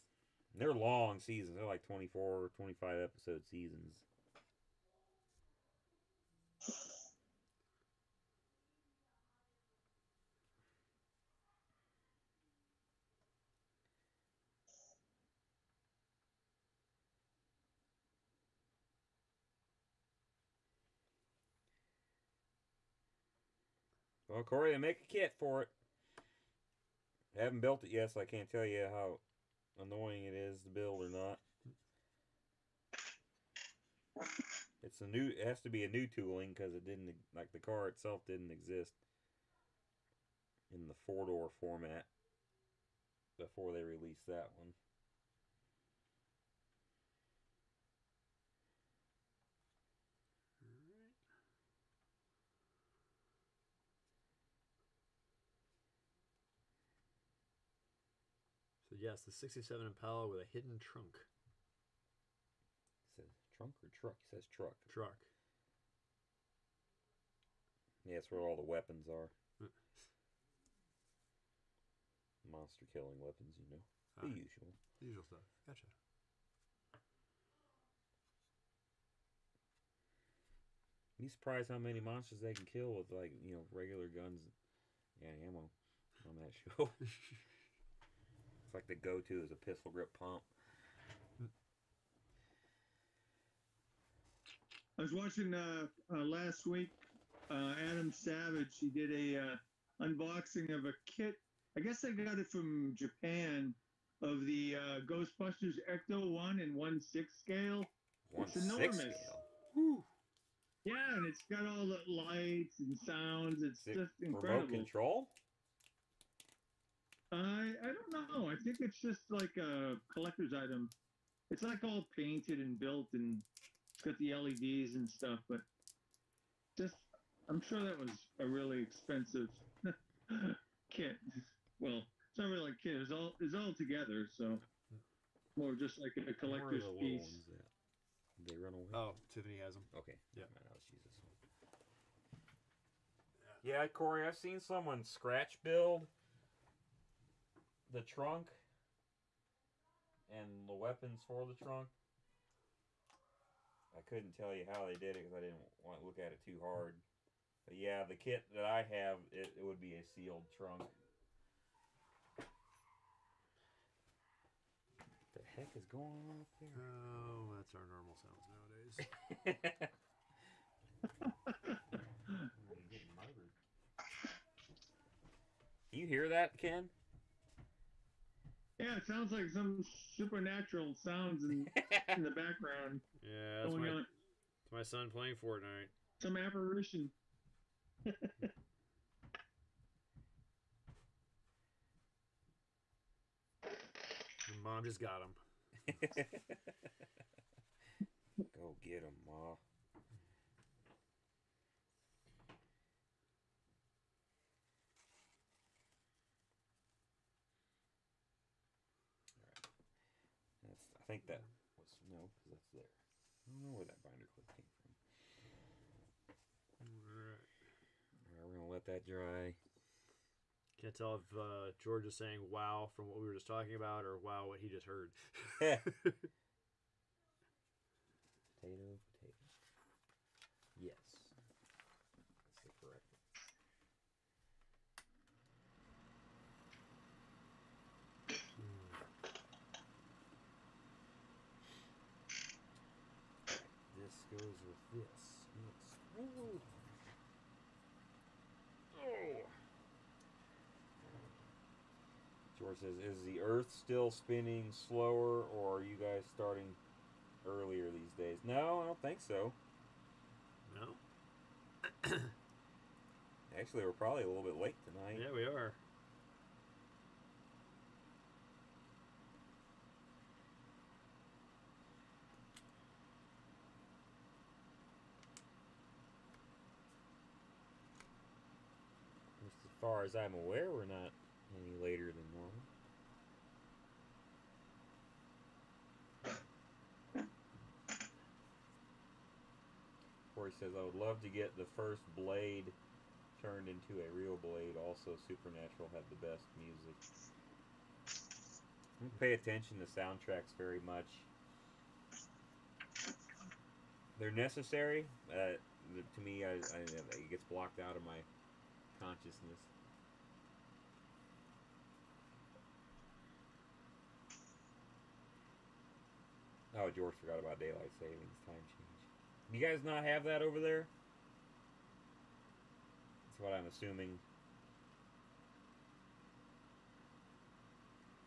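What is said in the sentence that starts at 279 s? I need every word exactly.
As far as I'm aware, we're not any later than normal.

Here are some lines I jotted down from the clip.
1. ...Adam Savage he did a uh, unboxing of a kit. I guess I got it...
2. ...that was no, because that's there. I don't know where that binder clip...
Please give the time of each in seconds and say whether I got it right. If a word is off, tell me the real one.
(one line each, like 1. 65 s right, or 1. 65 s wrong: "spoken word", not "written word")
1. 97 s right
2. 211 s right.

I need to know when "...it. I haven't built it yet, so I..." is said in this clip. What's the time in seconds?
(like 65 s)
25 s.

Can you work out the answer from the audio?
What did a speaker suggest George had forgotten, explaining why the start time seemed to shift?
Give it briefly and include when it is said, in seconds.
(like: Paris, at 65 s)
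daylight savings time, at 317 s.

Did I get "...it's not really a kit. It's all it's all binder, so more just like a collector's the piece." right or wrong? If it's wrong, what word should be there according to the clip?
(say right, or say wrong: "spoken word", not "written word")
wrong: "together", not "binder".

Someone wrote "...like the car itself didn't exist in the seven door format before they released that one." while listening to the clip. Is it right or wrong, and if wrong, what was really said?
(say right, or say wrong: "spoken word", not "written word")
wrong: "four", not "seven".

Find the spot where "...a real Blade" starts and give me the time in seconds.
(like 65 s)
294 s.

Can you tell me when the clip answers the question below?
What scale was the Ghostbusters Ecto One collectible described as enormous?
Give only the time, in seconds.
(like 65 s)
106 s.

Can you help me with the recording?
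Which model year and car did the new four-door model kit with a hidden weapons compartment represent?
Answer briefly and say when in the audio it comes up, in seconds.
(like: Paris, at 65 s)
67 Impala, at 59 s.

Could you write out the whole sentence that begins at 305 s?
Uh, to me, I, I, it gets blocked out of my consciousness.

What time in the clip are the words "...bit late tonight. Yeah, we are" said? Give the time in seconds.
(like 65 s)
264 s.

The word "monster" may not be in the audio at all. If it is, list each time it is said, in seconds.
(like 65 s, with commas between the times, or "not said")
72 s, 81 s.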